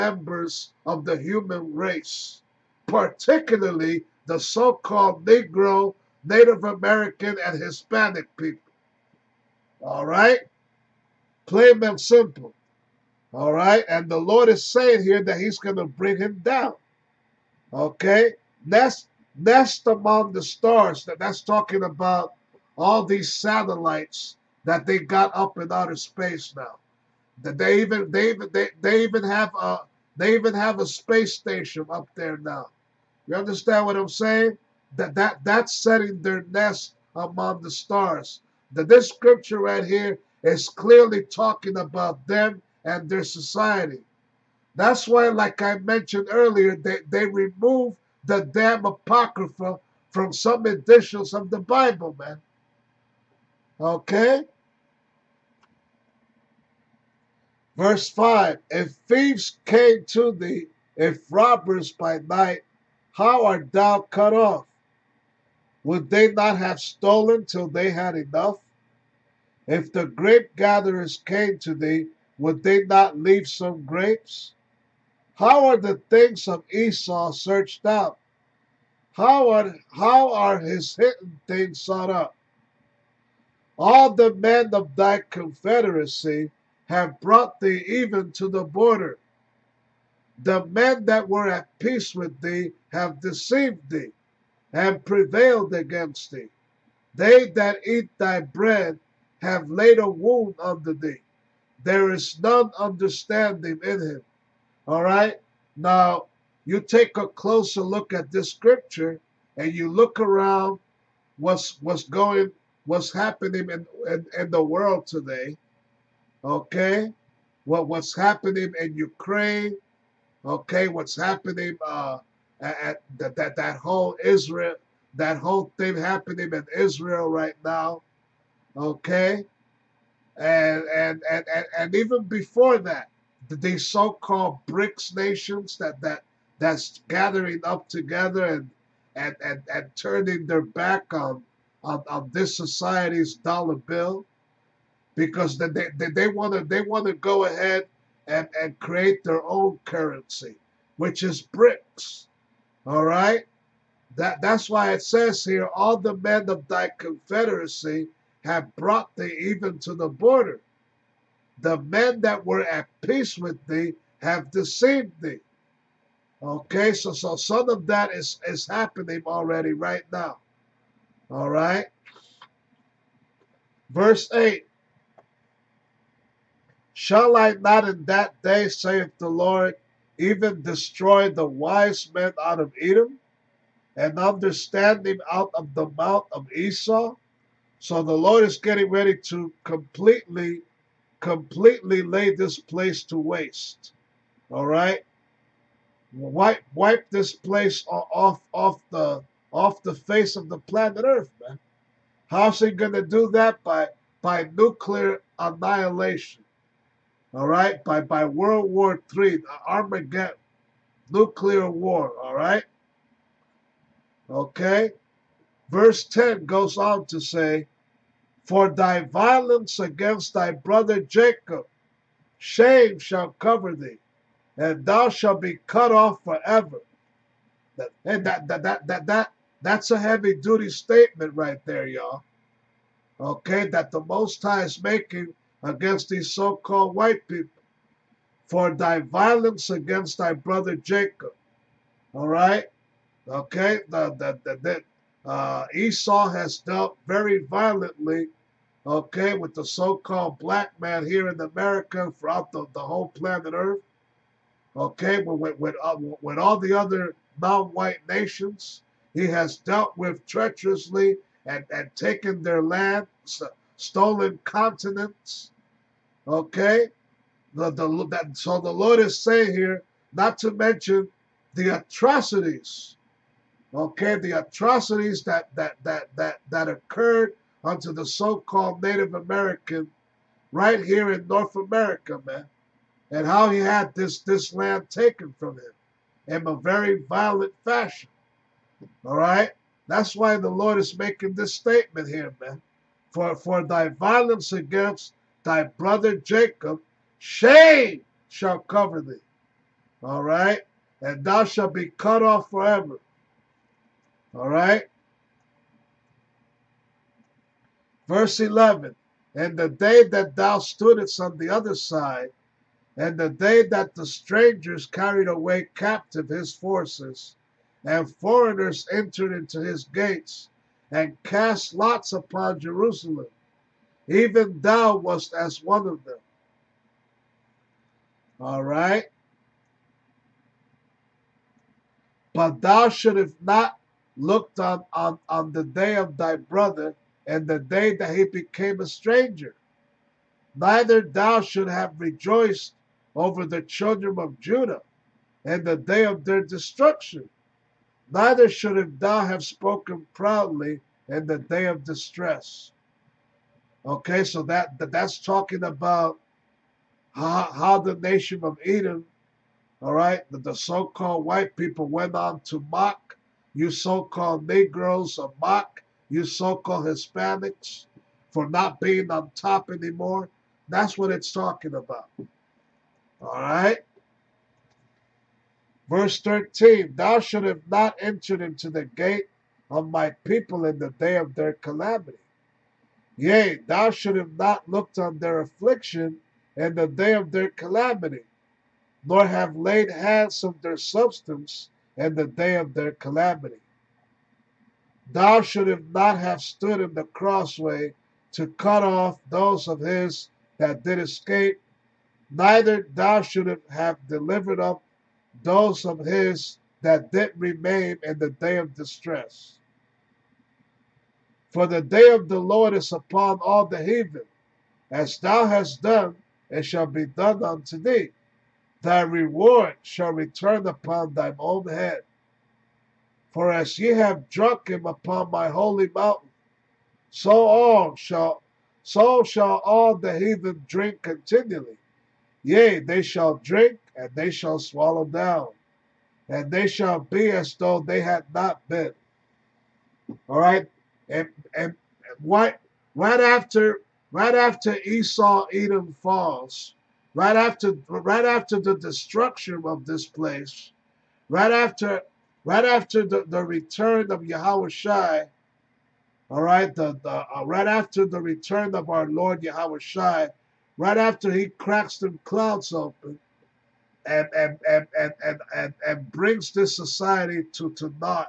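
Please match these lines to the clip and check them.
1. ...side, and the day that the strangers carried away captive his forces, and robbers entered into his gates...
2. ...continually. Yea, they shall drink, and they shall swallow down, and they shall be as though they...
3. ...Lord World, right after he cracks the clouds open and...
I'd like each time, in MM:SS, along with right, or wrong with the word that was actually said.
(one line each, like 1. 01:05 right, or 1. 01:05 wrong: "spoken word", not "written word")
1. 05:11 wrong: "foreigners", not "robbers"
2. 07:11 right
3. 07:39 wrong: "Yahushua", not "World".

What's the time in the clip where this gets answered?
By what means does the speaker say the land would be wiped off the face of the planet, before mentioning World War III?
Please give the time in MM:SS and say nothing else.
03:24.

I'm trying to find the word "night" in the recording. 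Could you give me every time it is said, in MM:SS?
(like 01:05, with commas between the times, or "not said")
01:02.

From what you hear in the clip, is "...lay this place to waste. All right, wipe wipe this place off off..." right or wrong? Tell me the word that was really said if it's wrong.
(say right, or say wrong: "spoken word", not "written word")
right.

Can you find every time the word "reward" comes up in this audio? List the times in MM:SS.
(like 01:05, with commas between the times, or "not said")
06:59.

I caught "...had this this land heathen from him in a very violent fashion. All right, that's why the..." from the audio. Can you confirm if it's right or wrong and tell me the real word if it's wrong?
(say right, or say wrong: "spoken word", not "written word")
wrong: "taken", not "heathen".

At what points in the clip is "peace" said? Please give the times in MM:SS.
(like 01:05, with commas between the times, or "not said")
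01:31, 02:43.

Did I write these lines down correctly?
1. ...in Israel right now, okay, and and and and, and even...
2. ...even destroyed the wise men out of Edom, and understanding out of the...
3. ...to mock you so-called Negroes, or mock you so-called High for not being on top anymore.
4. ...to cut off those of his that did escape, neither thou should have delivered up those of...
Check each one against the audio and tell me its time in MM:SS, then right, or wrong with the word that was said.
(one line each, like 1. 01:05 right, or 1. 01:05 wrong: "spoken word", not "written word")
1. 02:06 right
2. 03:00 right
3. 06:02 wrong: "Hispanics", not "High"
4. 06:38 right.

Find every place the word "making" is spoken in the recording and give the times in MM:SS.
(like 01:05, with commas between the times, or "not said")
03:54, 04:50.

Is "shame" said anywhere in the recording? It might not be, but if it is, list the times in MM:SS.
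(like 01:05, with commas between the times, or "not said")
03:42, 04:57.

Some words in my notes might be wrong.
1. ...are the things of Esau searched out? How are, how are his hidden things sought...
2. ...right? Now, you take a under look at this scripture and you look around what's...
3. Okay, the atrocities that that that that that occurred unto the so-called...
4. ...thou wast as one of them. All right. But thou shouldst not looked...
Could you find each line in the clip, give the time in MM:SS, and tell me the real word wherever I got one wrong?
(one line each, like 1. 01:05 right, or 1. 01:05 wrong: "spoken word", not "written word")
1. 01:15 right
2. 01:45 wrong: "closer", not "under"
3. 04:33 right
4. 05:24 right.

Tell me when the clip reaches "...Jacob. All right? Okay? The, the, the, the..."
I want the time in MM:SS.
04:00.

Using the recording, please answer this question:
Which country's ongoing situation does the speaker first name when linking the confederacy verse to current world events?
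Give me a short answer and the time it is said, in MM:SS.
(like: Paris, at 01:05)
Ukraine, at 01:58.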